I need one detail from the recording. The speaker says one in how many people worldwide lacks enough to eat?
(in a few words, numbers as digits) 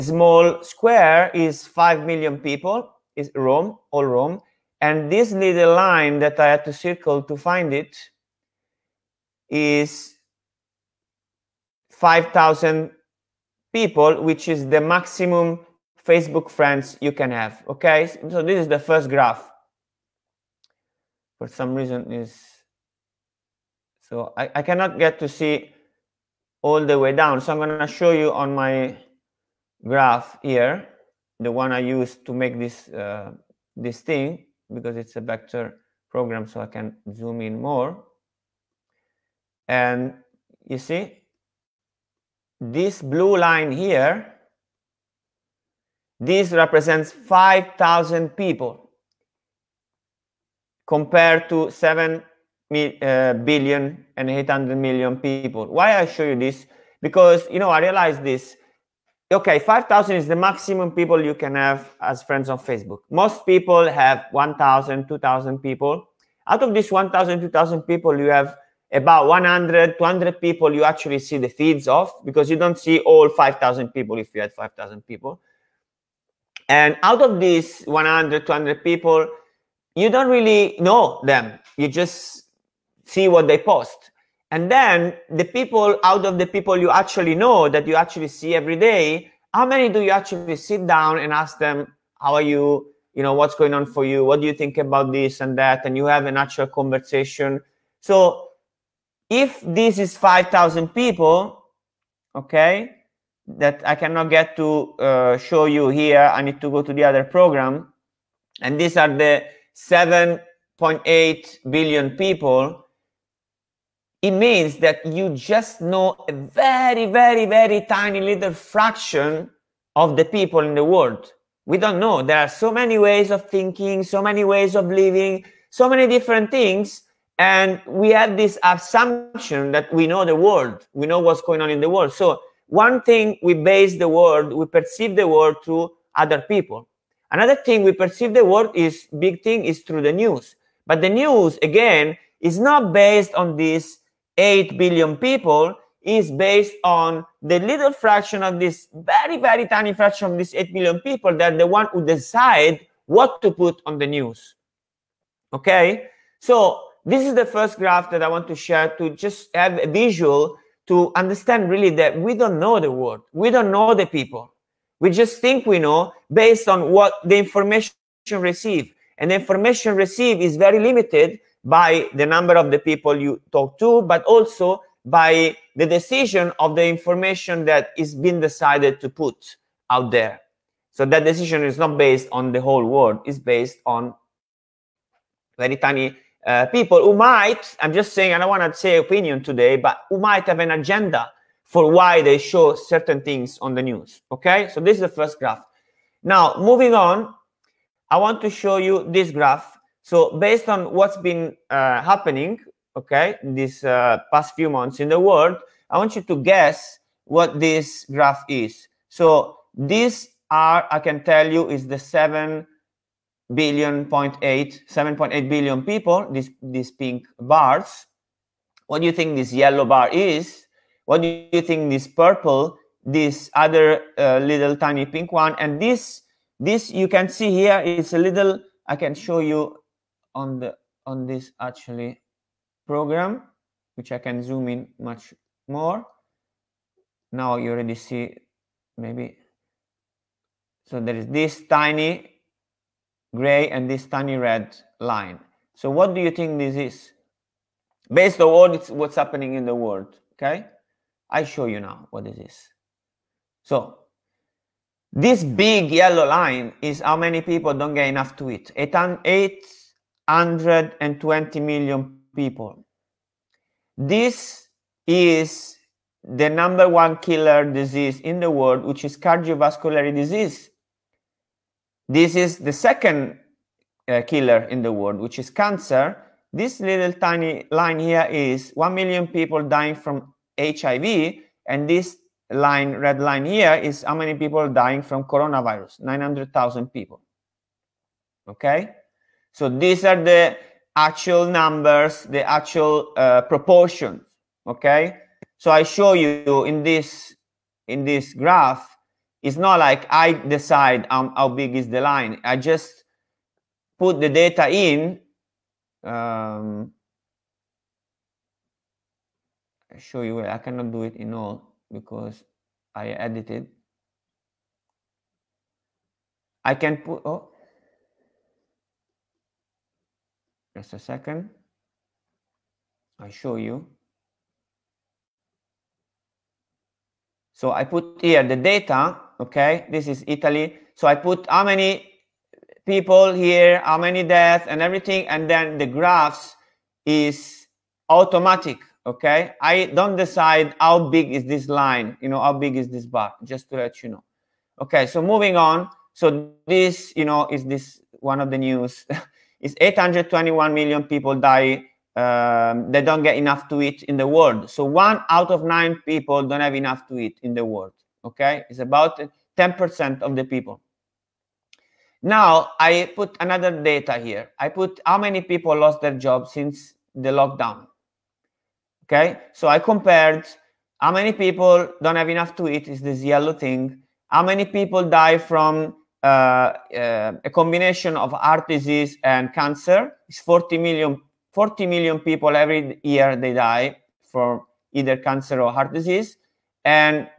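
9.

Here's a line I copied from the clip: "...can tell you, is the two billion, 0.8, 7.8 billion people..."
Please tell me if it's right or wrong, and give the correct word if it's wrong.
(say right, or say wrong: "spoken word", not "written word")
wrong: "seven", not "two".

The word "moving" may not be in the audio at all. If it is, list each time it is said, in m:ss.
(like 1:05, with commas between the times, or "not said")
3:16, 5:45.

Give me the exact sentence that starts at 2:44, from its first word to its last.
We just think we know based on what the information received.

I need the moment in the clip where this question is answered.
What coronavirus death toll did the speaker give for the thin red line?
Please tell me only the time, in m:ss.
4:46.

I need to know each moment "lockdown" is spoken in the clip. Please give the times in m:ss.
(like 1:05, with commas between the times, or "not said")
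6:07.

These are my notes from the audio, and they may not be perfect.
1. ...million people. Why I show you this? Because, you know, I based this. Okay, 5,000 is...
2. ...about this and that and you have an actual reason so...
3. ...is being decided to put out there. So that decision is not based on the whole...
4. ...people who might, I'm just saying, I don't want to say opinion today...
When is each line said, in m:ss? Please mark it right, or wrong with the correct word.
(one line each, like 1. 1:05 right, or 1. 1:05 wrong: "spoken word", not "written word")
1. 0:54 wrong: "realized", not "based"
2. 1:34 wrong: "conversation", not "reason"
3. 2:57 right
4. 3:06 right.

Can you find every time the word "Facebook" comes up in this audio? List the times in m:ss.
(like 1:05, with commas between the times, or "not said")
0:16, 1:02.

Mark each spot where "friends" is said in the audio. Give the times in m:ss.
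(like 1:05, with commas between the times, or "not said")
0:16, 1:02.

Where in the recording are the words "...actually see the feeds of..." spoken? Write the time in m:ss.
1:10.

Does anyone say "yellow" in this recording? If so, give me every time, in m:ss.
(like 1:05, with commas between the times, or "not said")
3:39, 4:15, 6:13.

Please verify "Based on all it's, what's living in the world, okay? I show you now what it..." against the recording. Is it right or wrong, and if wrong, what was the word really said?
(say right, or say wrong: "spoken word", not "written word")
wrong: "happening", not "living".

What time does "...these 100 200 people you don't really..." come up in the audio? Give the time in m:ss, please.
1:17.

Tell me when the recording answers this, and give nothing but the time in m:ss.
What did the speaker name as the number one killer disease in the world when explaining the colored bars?
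4:29.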